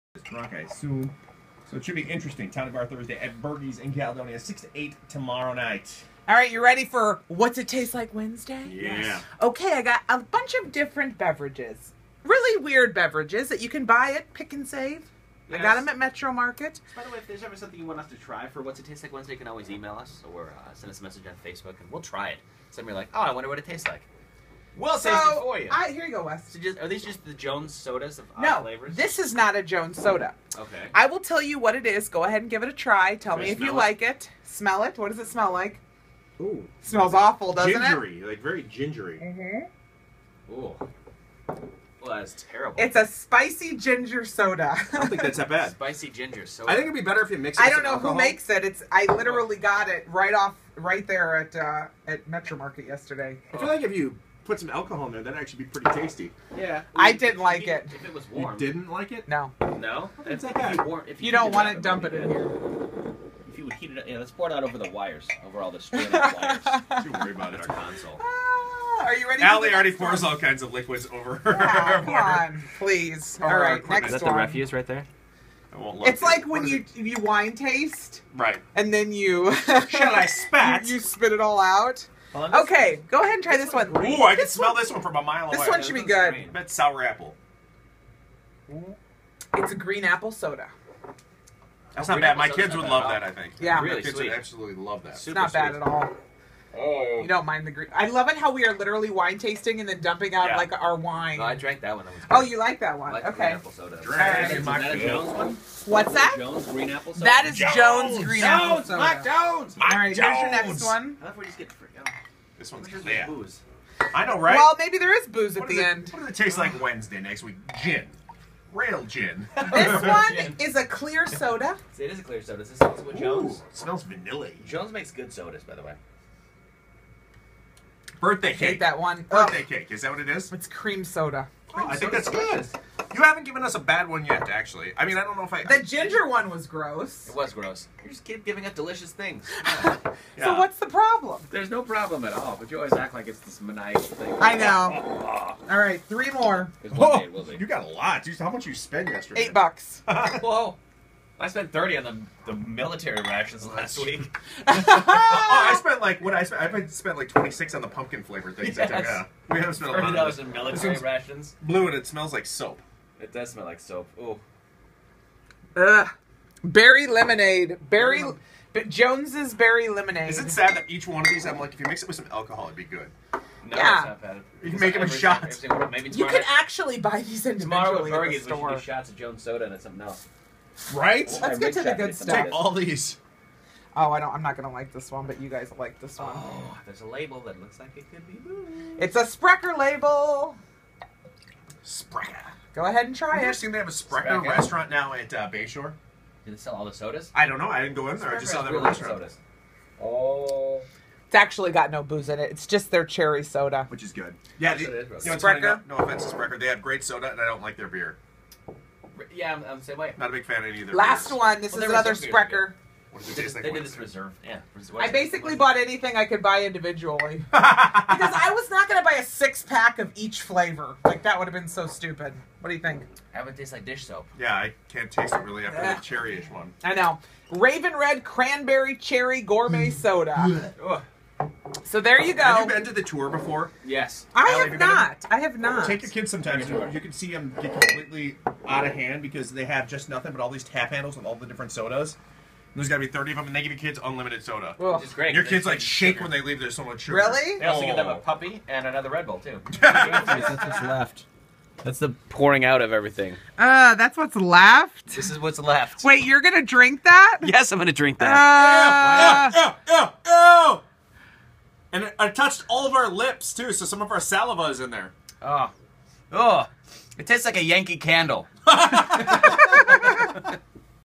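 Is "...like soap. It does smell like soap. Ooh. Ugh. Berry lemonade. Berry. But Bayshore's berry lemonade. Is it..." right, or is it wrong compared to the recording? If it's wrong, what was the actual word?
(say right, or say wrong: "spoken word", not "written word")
wrong: "Jones", not "Bayshore".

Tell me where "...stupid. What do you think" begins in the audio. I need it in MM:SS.
03:41.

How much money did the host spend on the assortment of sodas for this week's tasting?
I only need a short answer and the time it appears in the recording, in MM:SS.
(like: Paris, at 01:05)
$8, at 02:29.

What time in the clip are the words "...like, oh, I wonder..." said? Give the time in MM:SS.
00:22.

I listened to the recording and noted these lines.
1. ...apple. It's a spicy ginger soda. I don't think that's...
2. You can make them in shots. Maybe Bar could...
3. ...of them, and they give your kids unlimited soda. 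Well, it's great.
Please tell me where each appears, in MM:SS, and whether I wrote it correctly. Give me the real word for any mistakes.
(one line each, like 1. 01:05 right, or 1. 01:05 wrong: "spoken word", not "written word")
1. 00:42 wrong: "terrible", not "apple"
2. 02:54 wrong: "You", not "Bar"
3. 04:03 right.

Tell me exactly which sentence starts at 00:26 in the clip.
So just, are these just the Jones sodas of odd no, this is not a Jones soda.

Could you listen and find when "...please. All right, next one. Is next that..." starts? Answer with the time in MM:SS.
01:12.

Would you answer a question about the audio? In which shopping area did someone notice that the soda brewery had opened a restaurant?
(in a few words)
Bayshore.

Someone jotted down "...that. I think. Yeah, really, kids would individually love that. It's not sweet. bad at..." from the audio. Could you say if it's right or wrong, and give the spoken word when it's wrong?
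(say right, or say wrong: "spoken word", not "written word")
wrong: "absolutely", not "individually".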